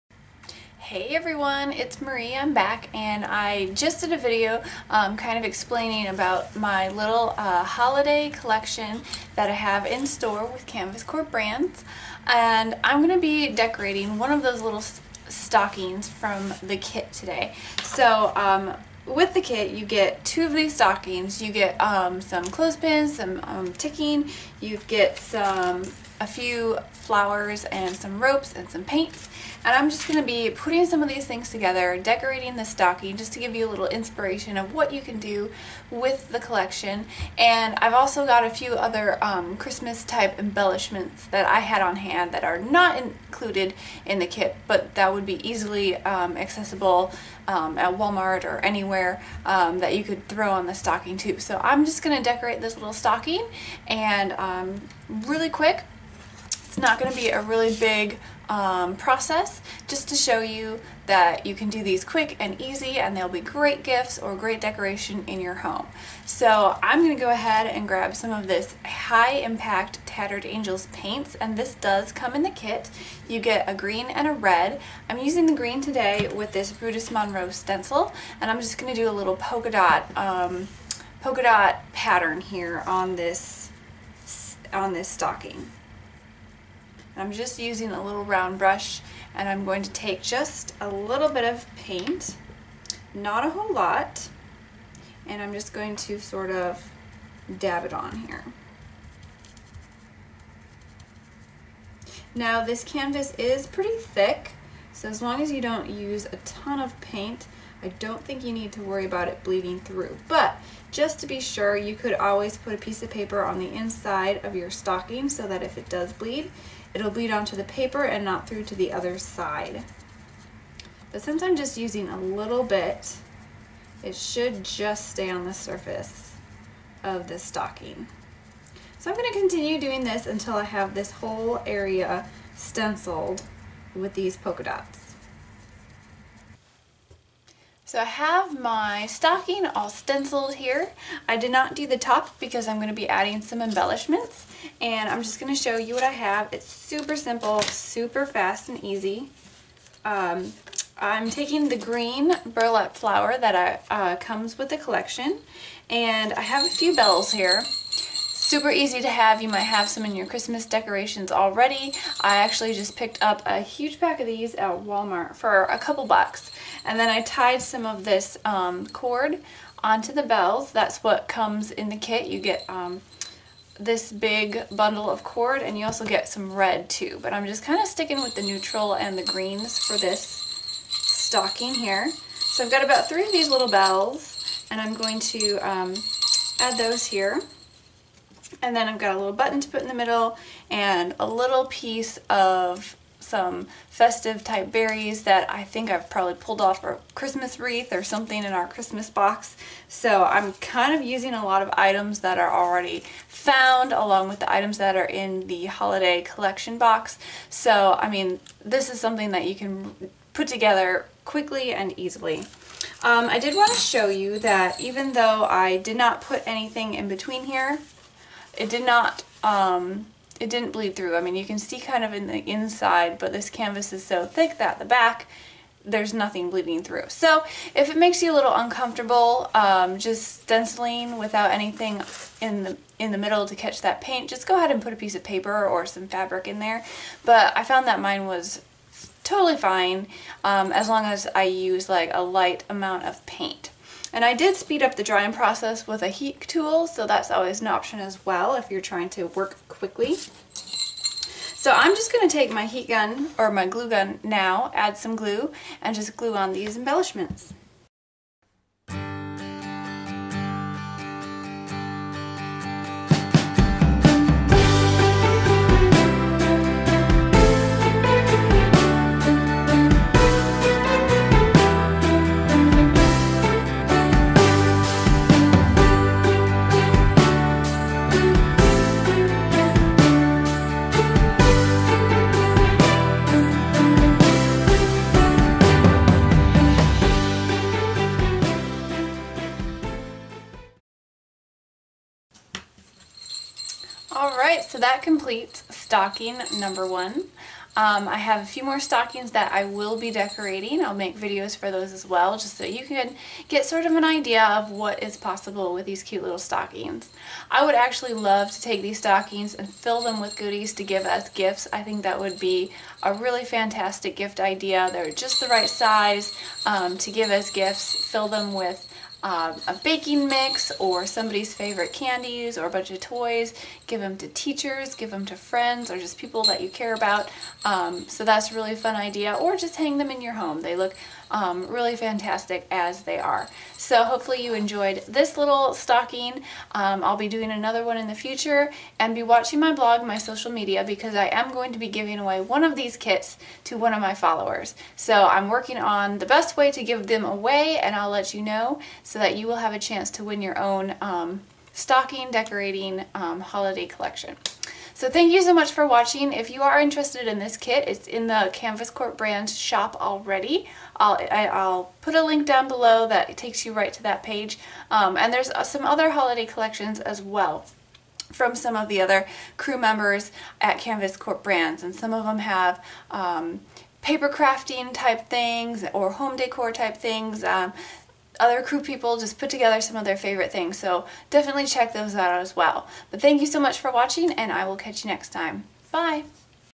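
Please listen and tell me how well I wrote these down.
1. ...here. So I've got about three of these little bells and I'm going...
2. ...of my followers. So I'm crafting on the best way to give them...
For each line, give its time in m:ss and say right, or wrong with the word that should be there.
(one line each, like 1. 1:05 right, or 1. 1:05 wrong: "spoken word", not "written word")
1. 3:01 right
2. 5:43 wrong: "working", not "crafting".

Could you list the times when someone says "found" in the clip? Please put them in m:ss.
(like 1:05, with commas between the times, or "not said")
3:23, 3:57.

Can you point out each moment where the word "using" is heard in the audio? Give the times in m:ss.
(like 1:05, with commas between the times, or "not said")
1:15, 1:27, 2:01, 3:21.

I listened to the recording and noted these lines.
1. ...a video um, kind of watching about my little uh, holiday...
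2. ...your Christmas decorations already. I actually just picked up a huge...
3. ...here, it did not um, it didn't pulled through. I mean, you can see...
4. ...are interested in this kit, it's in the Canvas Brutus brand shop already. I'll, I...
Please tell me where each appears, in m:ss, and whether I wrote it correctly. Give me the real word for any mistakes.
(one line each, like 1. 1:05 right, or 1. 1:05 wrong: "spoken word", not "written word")
1. 0:04 wrong: "explaining", not "watching"
2. 2:40 right
3. 3:37 wrong: "bleed", not "pulled"
4. 5:56 wrong: "Corp", not "Brutus".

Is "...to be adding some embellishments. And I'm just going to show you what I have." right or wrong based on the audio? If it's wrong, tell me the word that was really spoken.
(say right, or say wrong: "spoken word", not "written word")
right.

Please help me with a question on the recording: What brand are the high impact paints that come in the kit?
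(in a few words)
Tattered Angels.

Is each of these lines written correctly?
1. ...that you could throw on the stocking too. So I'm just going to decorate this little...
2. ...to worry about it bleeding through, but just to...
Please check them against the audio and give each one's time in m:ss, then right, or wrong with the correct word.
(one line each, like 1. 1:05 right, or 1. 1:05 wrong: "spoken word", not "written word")
1. 0:49 right
2. 1:48 right.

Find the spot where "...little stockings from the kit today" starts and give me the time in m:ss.
0:14.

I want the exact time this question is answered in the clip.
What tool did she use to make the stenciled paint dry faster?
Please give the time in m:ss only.
4:06.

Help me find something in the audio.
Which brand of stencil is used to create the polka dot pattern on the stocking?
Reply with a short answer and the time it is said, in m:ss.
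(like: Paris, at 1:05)
Brutus Monroe, at 1:16.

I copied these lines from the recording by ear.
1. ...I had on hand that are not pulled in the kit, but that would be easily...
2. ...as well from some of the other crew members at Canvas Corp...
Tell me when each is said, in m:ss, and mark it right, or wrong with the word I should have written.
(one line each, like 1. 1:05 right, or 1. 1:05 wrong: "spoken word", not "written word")
1. 0:41 wrong: "included", not "pulled"
2. 6:06 right.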